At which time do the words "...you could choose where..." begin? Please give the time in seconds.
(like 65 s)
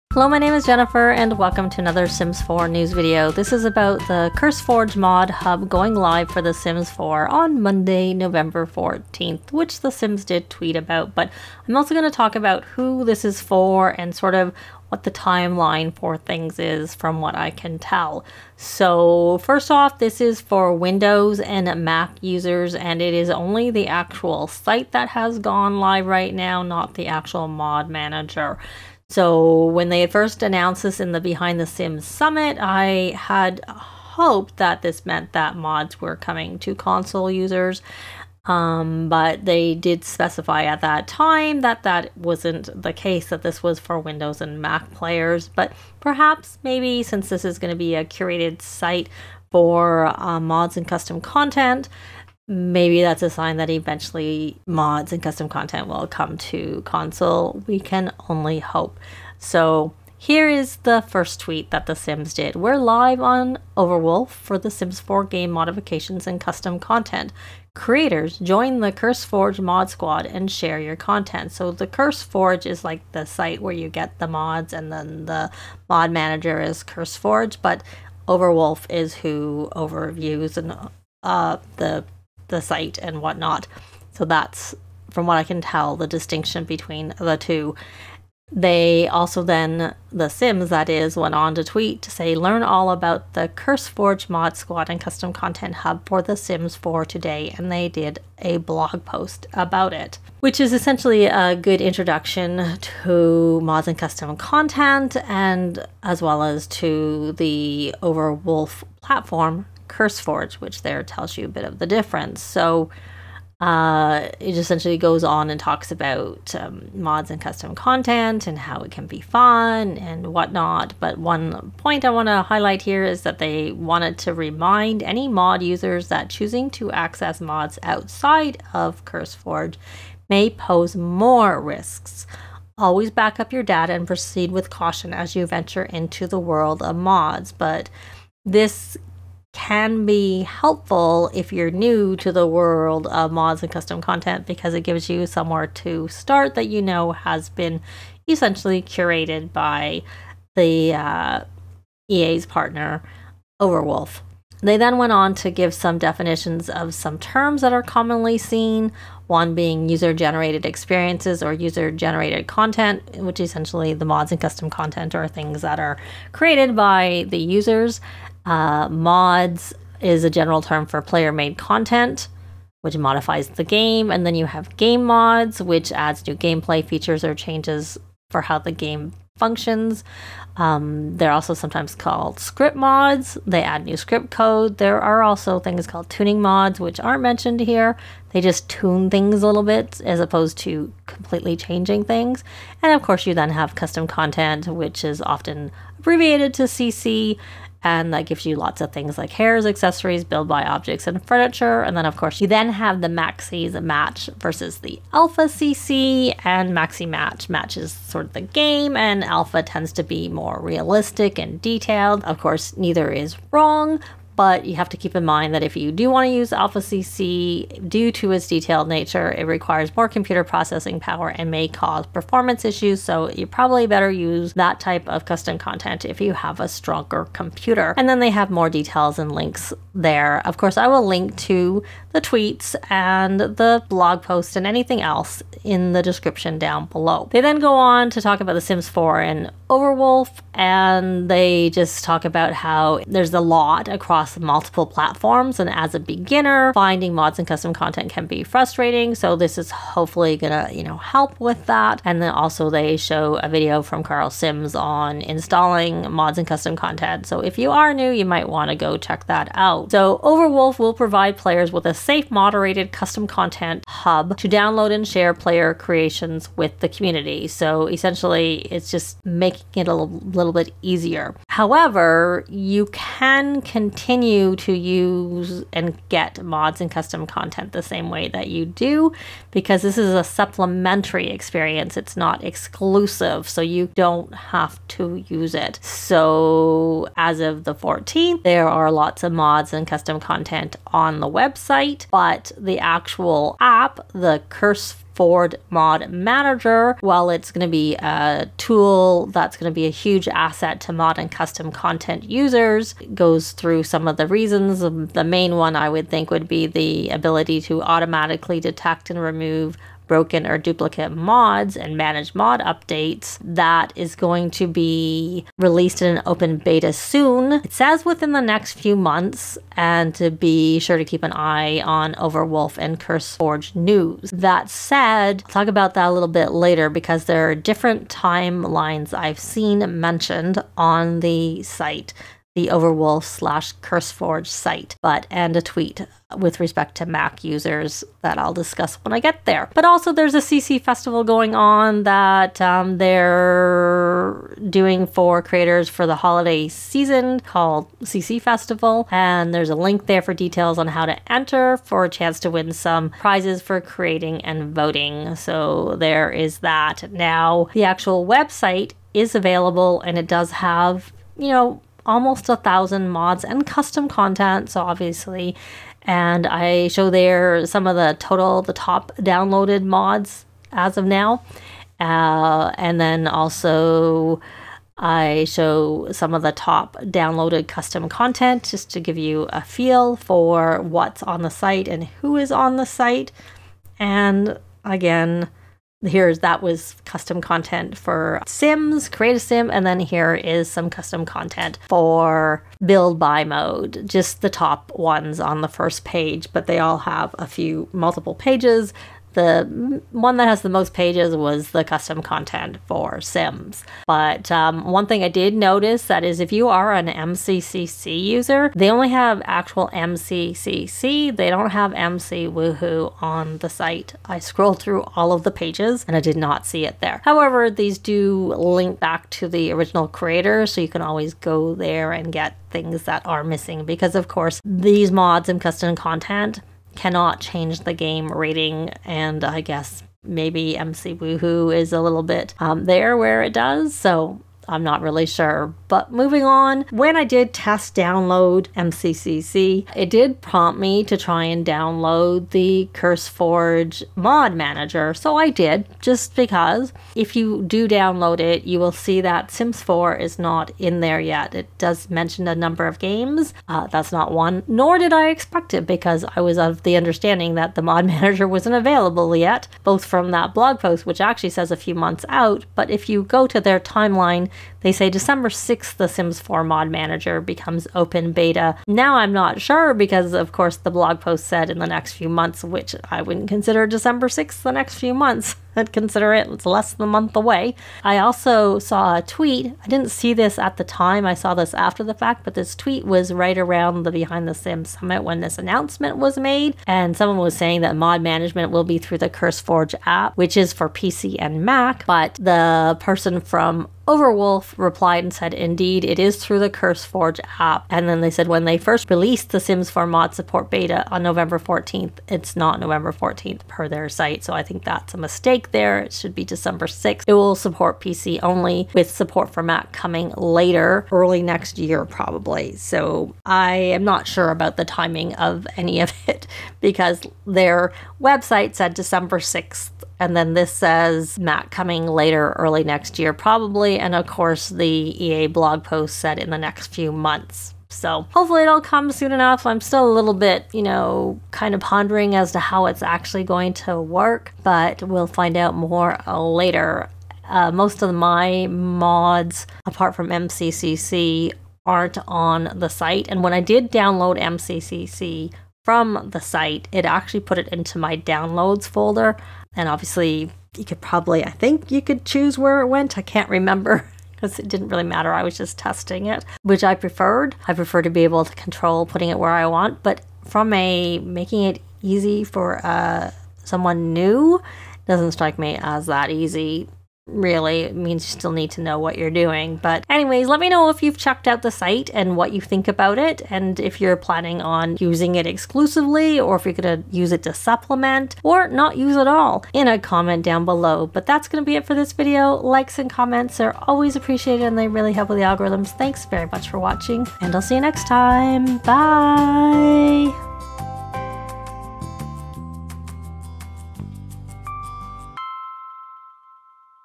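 551 s.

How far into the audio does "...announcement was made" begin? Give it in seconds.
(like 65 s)
485 s.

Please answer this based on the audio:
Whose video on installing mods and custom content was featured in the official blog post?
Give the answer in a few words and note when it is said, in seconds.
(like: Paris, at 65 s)
Carl's Sims, at 254 s.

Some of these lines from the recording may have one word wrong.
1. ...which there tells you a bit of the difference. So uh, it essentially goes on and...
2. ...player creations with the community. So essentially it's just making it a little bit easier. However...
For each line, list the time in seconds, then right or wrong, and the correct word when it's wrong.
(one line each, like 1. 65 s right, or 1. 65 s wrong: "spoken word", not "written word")
1. 110 s right
2. 265 s right.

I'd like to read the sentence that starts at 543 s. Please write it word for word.
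And when I did download MCCC from the site, it actually put it into my downloads folder.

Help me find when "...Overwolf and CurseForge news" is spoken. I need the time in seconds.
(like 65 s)
322 s.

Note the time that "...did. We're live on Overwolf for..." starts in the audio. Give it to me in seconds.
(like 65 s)
62 s.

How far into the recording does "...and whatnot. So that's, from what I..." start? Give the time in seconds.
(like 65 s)
83 s.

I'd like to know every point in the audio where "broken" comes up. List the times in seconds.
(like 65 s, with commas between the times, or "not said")
310 s.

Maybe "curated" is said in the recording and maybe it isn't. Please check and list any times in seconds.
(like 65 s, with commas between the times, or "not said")
48 s, 148 s.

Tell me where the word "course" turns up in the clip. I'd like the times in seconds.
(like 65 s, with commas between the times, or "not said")
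193 s, 202 s, 212 s, 230 s, 424 s, 470 s, 524 s.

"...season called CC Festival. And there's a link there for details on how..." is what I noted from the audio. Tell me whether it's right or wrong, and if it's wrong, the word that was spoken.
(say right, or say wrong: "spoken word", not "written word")
right.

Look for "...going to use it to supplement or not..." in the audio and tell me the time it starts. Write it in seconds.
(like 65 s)
576 s.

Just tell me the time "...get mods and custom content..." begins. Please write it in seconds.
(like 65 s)
276 s.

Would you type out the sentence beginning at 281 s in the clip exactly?
It's not exclusive, so you don't have to use it.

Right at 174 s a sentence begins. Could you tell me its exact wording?
And then you have game mods, which adds new gameplay features or changes for how the game functions.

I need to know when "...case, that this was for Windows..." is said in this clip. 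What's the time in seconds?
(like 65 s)
42 s.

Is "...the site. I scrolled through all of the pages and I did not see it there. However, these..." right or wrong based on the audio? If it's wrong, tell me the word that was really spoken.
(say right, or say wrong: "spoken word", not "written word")
right.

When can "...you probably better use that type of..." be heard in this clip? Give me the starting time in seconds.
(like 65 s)
223 s.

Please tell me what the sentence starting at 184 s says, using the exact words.
There are also things called tuning mods, which aren't mentioned here.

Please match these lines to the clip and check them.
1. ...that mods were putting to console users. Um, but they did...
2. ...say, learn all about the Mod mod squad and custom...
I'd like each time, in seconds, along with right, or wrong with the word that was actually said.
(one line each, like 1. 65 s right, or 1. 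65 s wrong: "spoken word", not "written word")
1. 35 s wrong: "coming", not "putting"
2. 92 s wrong: "CurseForge", not "Mod".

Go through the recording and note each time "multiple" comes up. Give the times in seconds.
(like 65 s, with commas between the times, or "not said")
244 s, 397 s.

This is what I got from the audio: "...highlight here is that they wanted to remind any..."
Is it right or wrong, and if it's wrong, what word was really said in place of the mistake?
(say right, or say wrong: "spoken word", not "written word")
right.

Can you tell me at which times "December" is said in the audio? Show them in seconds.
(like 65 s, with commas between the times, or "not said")
465 s, 473 s, 506 s, 518 s.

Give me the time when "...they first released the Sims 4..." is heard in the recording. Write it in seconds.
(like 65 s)
498 s.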